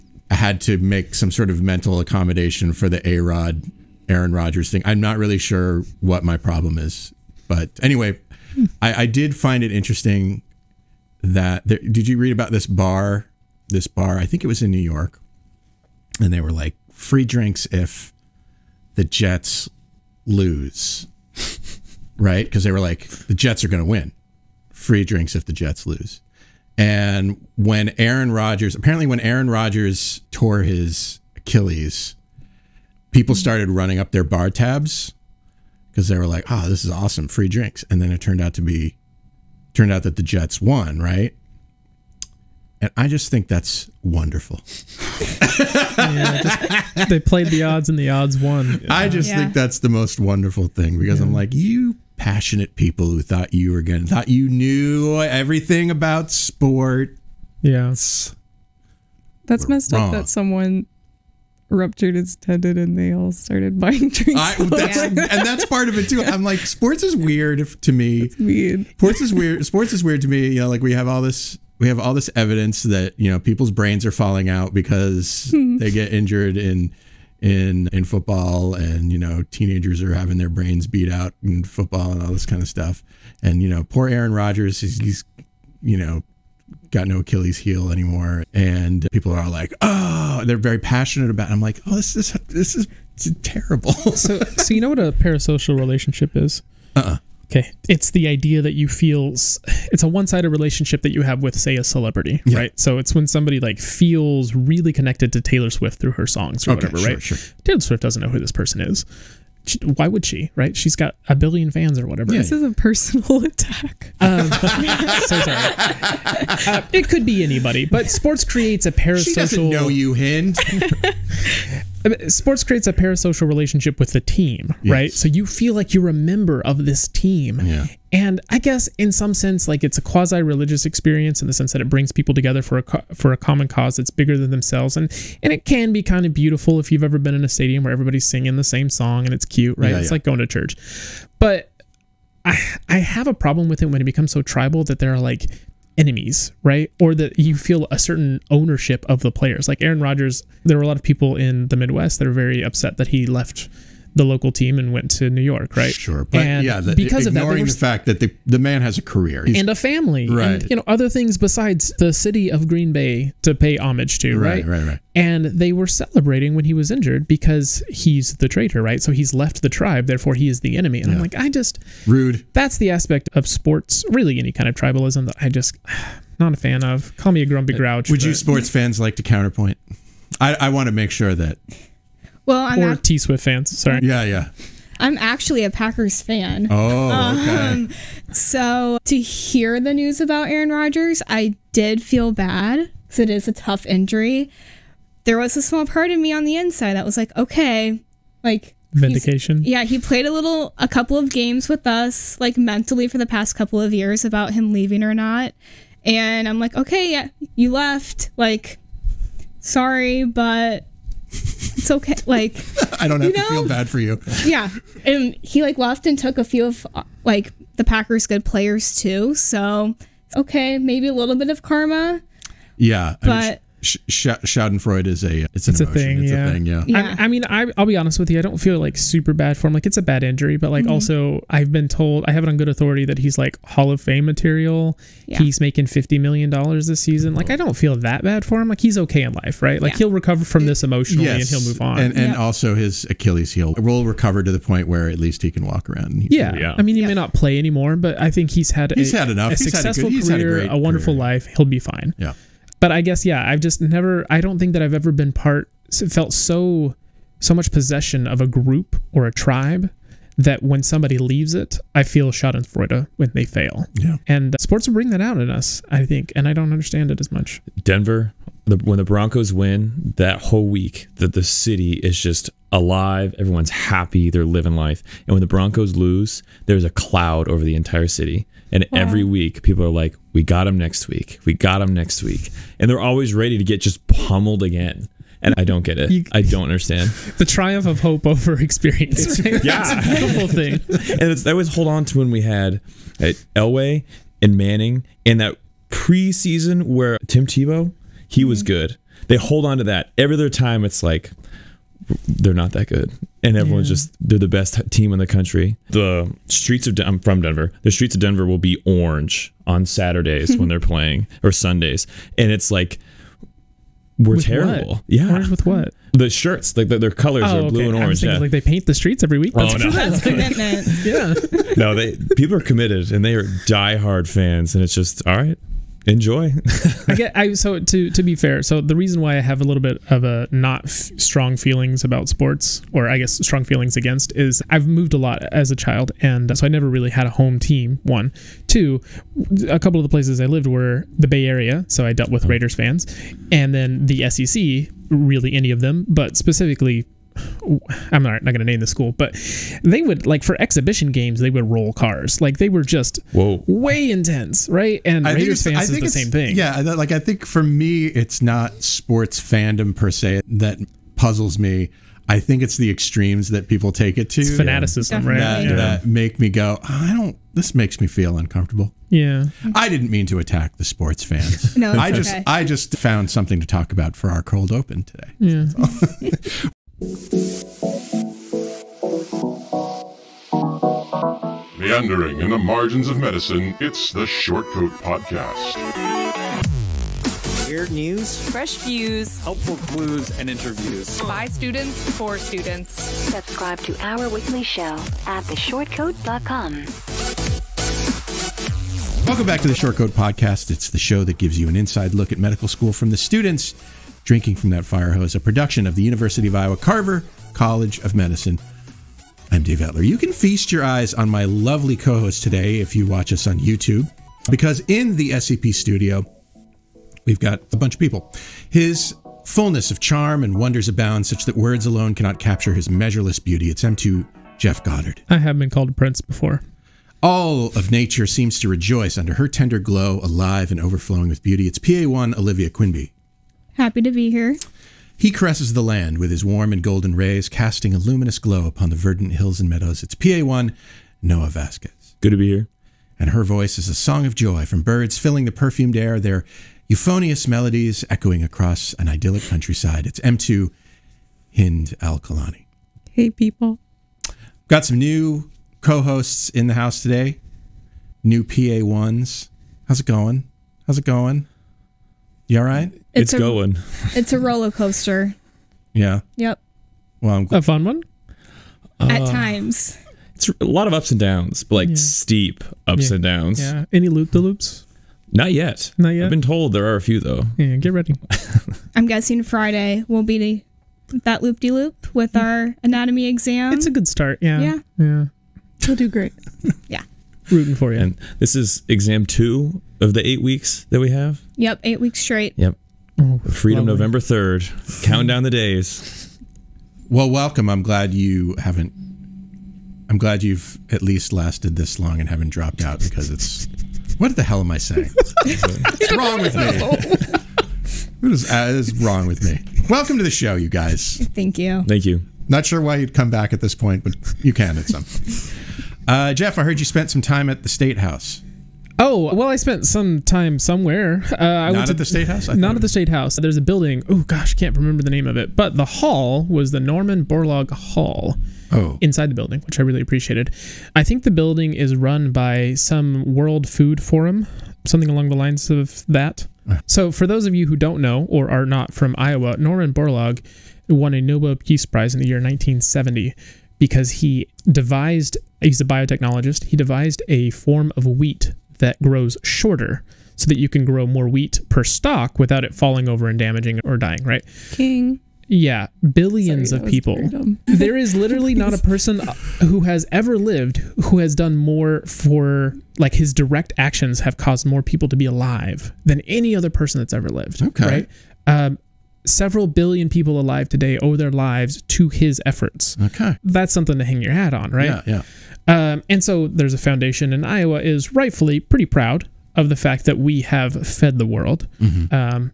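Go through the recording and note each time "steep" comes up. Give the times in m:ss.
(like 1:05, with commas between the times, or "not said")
7:51.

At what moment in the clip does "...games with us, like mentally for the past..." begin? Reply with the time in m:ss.
3:21.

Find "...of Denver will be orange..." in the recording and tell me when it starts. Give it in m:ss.
5:08.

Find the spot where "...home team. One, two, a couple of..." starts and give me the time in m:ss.
5:37.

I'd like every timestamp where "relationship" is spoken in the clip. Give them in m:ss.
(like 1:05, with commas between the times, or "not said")
1:35, 1:40, 2:03.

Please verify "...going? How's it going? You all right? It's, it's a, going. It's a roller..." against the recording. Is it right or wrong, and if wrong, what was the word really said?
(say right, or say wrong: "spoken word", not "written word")
right.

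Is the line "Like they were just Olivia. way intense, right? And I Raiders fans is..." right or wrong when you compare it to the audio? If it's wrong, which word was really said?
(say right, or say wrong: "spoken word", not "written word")
wrong: "Whoa", not "Olivia".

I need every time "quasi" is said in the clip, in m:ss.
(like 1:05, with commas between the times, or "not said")
2:10.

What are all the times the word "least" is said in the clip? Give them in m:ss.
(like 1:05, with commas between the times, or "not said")
4:05, 8:21.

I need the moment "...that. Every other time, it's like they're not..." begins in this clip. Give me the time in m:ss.
4:59.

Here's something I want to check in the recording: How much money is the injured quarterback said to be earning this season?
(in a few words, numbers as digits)
50 million dollars.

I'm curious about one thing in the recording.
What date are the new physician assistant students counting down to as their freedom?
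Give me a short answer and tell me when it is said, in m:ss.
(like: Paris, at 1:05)
November 3, at 8:14.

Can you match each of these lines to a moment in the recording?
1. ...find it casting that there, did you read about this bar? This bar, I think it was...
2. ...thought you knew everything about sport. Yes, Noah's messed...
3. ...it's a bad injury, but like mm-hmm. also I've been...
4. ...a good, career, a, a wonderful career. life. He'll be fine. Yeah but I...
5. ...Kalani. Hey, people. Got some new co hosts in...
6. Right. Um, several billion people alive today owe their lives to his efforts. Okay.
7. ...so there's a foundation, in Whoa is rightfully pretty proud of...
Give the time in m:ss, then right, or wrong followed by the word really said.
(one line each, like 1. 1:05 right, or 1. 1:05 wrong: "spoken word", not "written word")
1. 0:09 wrong: "interesting", not "casting"
2. 0:54 wrong: "That", not "Noah"
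3. 3:49 right
4. 4:10 right
5. 7:32 right
6. 9:27 right
7. 9:36 wrong: "Iowa", not "Whoa".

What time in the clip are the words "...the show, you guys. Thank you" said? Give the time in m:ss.
8:30.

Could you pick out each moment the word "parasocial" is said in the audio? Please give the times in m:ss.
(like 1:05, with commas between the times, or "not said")
1:35, 1:58, 2:02.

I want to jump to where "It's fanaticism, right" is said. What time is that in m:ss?
6:04.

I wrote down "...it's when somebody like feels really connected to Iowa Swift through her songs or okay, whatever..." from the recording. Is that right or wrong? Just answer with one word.
wrong.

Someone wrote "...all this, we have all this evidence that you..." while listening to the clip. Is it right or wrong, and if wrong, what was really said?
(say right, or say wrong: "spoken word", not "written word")
right.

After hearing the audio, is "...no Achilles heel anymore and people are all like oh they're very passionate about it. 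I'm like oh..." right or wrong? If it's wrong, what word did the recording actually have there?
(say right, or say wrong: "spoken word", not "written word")
right.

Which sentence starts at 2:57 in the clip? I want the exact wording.
Call me a grumpy uh, grouch.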